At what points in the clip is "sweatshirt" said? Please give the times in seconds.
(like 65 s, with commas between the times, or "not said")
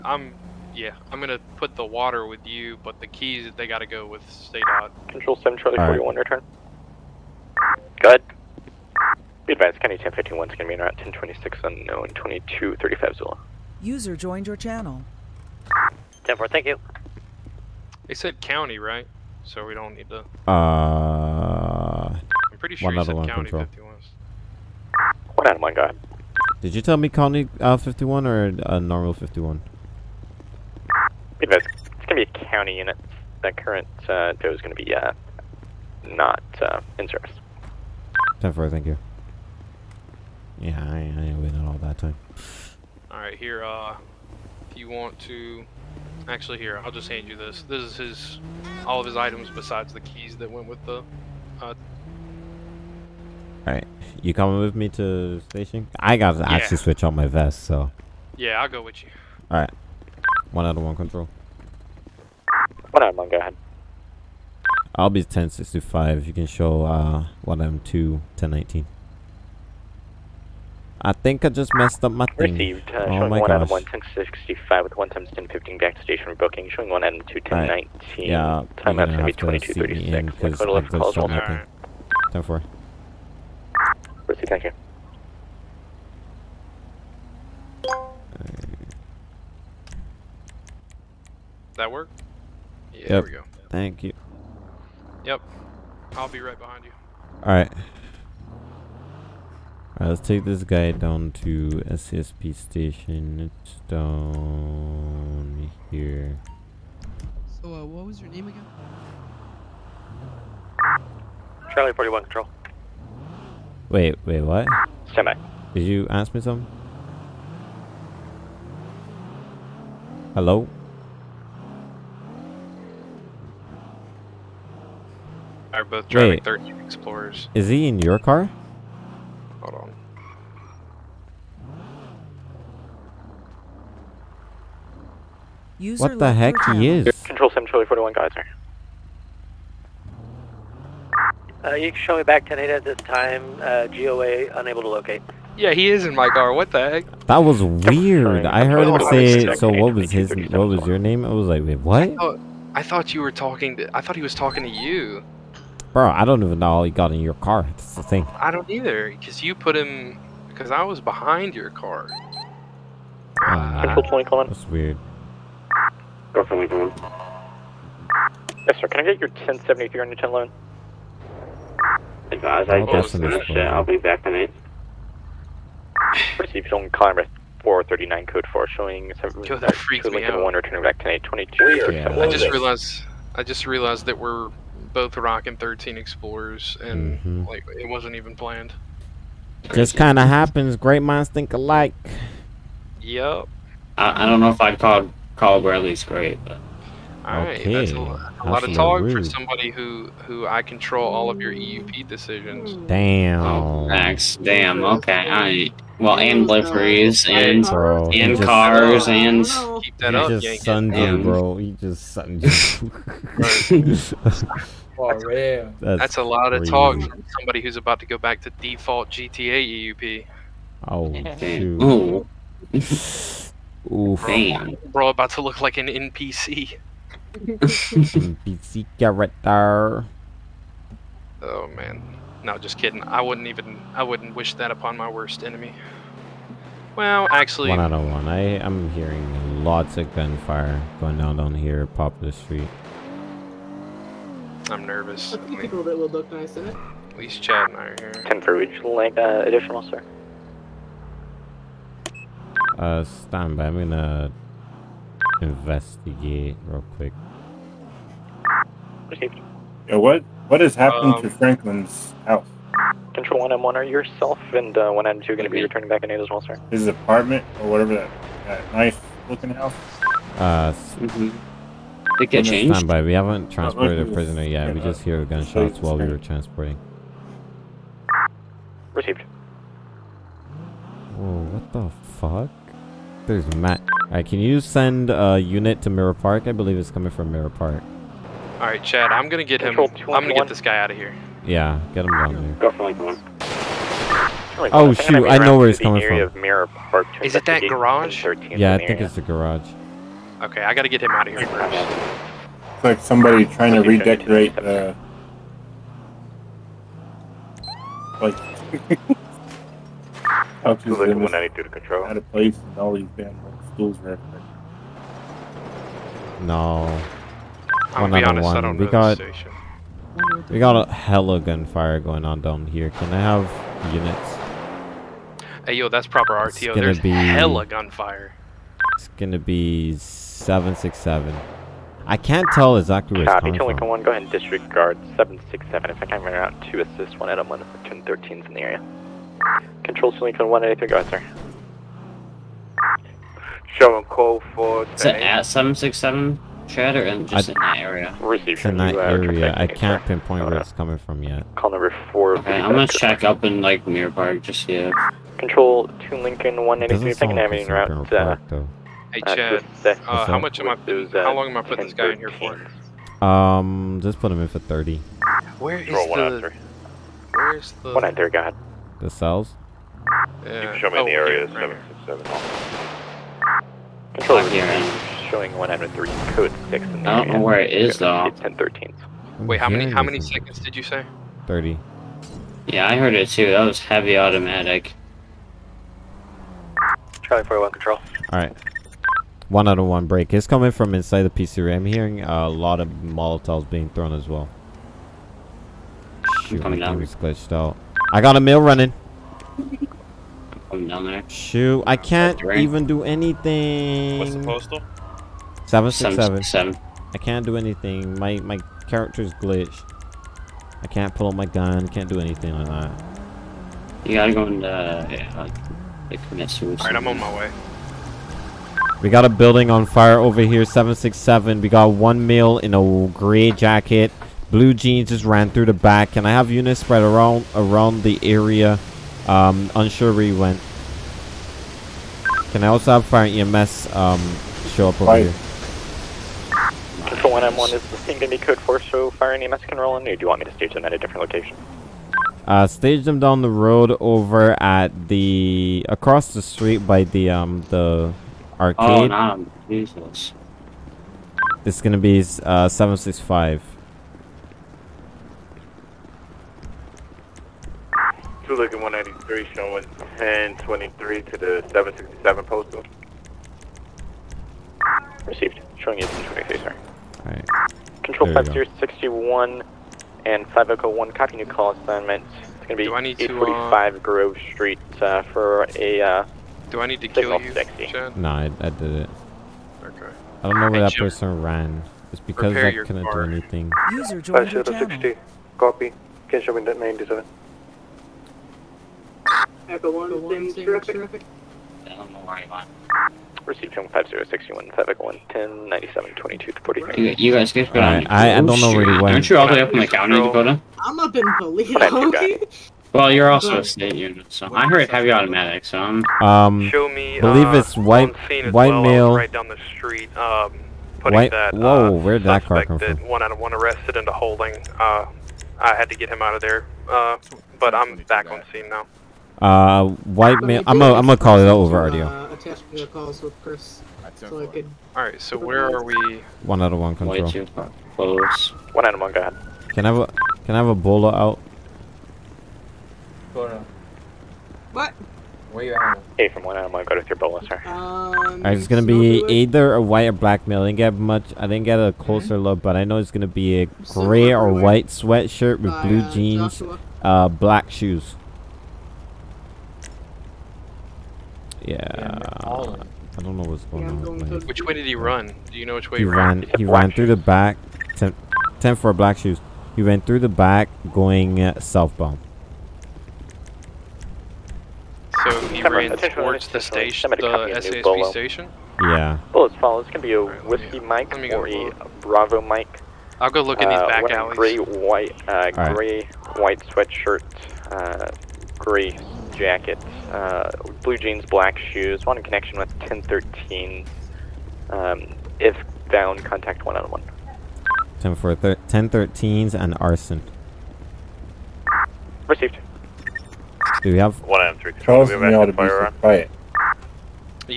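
544 s, 576 s.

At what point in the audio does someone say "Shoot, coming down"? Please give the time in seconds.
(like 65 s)
396 s.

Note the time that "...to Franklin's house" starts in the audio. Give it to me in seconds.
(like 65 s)
261 s.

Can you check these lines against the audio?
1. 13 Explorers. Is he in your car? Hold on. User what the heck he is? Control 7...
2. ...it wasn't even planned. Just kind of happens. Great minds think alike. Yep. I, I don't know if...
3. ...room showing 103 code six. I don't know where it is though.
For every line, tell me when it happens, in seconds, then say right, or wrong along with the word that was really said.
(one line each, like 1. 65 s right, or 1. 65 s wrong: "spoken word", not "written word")
1. 126 s right
2. 187 s right
3. 374 s right.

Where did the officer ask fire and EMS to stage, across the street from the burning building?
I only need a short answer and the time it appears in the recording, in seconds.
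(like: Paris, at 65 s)
the Arcade, at 448 s.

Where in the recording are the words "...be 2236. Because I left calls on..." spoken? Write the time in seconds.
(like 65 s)
79 s.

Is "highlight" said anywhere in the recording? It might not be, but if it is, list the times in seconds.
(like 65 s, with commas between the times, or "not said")
not said.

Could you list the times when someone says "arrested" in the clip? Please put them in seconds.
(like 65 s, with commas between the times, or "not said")
513 s.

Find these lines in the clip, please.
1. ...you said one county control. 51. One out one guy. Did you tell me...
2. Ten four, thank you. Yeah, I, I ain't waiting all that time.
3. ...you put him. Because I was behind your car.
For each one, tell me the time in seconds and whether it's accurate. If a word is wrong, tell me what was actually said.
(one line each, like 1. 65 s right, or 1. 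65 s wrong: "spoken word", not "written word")
1. 22 s right
2. 38 s right
3. 159 s right.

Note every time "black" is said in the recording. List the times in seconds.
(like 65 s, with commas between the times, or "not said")
540 s, 547 s, 558 s, 581 s.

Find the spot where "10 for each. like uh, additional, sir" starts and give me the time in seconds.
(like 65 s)
248 s.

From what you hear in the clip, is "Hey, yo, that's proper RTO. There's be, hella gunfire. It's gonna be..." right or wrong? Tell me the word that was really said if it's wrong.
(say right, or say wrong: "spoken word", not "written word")
right.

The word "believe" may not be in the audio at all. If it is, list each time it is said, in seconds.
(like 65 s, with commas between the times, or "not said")
286 s, 507 s.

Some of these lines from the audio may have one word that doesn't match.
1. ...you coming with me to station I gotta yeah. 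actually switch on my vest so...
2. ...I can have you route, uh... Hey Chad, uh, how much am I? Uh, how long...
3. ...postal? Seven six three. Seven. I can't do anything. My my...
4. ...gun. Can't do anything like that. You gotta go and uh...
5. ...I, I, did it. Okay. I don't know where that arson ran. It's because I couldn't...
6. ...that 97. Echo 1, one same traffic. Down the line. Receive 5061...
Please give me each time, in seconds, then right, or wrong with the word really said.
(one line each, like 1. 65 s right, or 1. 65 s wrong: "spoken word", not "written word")
1. 54 s right
2. 357 s right
3. 404 s wrong: "seven", not "three"
4. 411 s right
5. 478 s wrong: "person", not "arson"
6. 486 s right.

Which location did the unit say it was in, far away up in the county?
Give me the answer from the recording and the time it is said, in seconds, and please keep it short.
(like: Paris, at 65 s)
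Paleto, at 501 s.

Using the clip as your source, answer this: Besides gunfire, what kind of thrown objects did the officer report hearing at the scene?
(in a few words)
Molotovs.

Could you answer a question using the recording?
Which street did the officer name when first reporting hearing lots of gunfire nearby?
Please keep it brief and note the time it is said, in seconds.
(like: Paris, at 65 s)
Poplar Street, at 241 s.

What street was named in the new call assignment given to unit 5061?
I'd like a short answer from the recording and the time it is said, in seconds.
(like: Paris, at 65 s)
Grove Street, at 473 s.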